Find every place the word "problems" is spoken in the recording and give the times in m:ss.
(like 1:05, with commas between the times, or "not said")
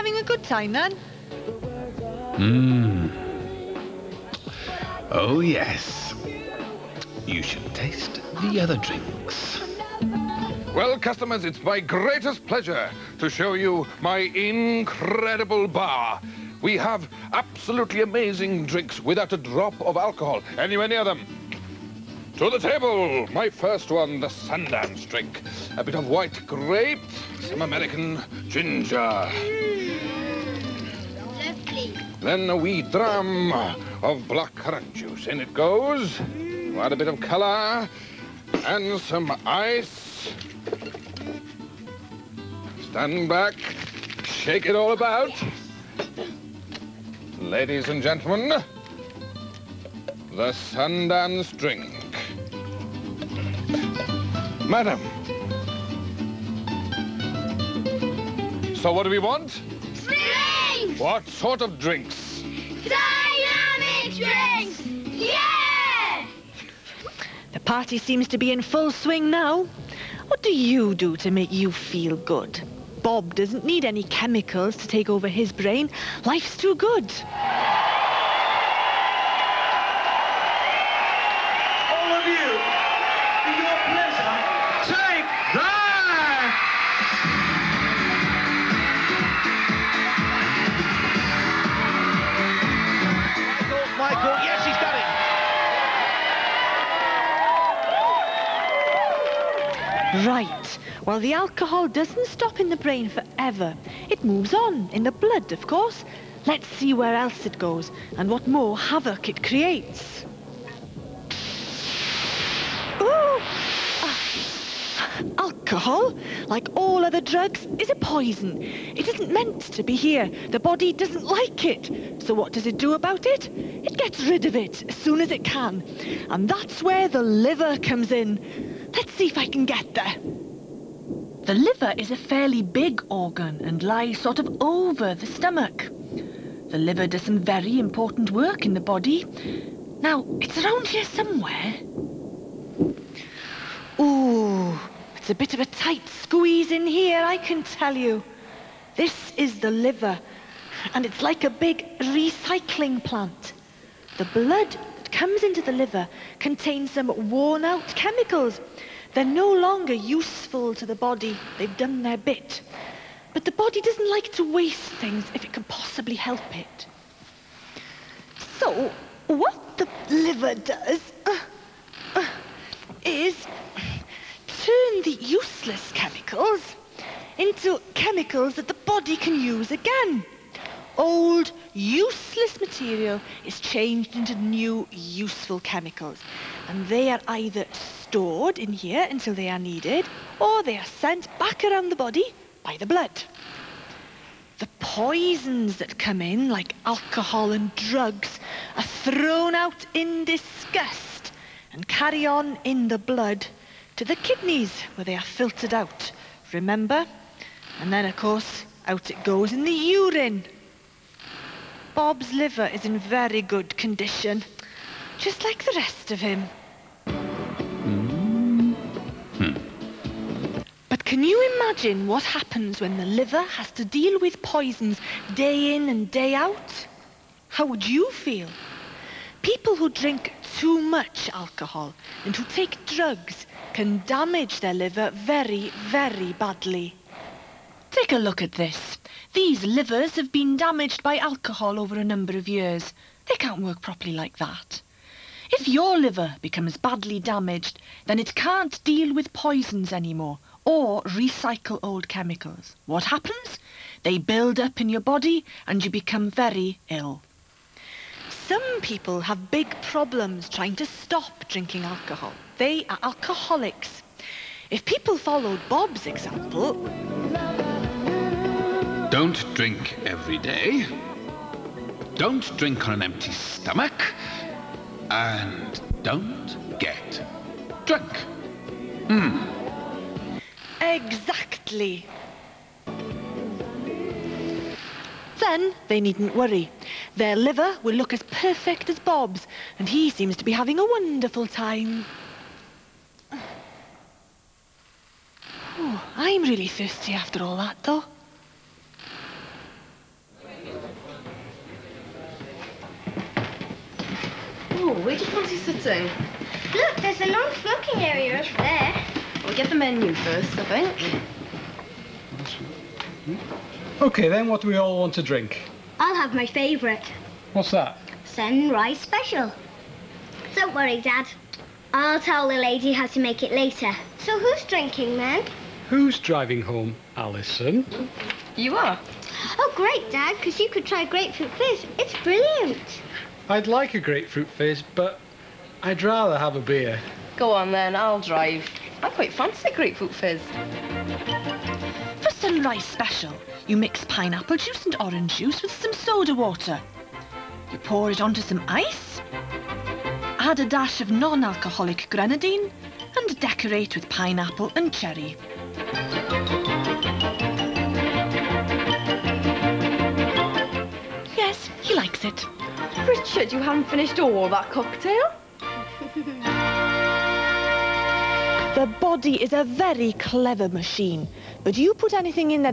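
4:19.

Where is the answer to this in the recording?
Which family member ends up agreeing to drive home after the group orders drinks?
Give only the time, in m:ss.
5:27.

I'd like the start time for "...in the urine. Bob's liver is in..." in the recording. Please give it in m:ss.
3:29.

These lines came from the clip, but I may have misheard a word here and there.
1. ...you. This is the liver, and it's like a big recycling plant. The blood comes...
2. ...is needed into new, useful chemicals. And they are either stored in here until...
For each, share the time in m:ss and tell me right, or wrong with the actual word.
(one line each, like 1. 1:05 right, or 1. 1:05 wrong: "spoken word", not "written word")
1. 2:27 right
2. 3:03 wrong: "changed", not "needed".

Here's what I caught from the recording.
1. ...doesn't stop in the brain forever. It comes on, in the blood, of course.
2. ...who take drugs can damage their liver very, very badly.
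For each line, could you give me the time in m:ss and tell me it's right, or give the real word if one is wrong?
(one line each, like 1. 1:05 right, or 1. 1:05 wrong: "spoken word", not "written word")
1. 1:41 wrong: "moves", not "comes"
2. 3:52 right.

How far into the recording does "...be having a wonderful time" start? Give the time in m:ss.
4:50.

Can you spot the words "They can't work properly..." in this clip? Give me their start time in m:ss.
4:03.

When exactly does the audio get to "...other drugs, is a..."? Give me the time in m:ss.
1:57.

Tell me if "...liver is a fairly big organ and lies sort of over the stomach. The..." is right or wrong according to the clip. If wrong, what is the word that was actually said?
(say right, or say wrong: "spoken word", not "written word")
right.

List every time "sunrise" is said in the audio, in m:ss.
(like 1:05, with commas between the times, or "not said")
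5:18, 5:42.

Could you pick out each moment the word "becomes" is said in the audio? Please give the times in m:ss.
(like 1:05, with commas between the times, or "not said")
4:06, 4:15.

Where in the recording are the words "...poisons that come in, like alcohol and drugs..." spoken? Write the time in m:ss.
3:14.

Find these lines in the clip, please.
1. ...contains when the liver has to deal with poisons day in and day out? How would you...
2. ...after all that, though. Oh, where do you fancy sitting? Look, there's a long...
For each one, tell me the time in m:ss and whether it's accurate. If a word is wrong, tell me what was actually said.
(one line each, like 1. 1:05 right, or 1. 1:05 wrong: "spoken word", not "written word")
1. 3:42 wrong: "happens", not "contains"
2. 4:57 right.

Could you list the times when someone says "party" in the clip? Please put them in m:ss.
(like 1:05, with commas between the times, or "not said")
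1:07.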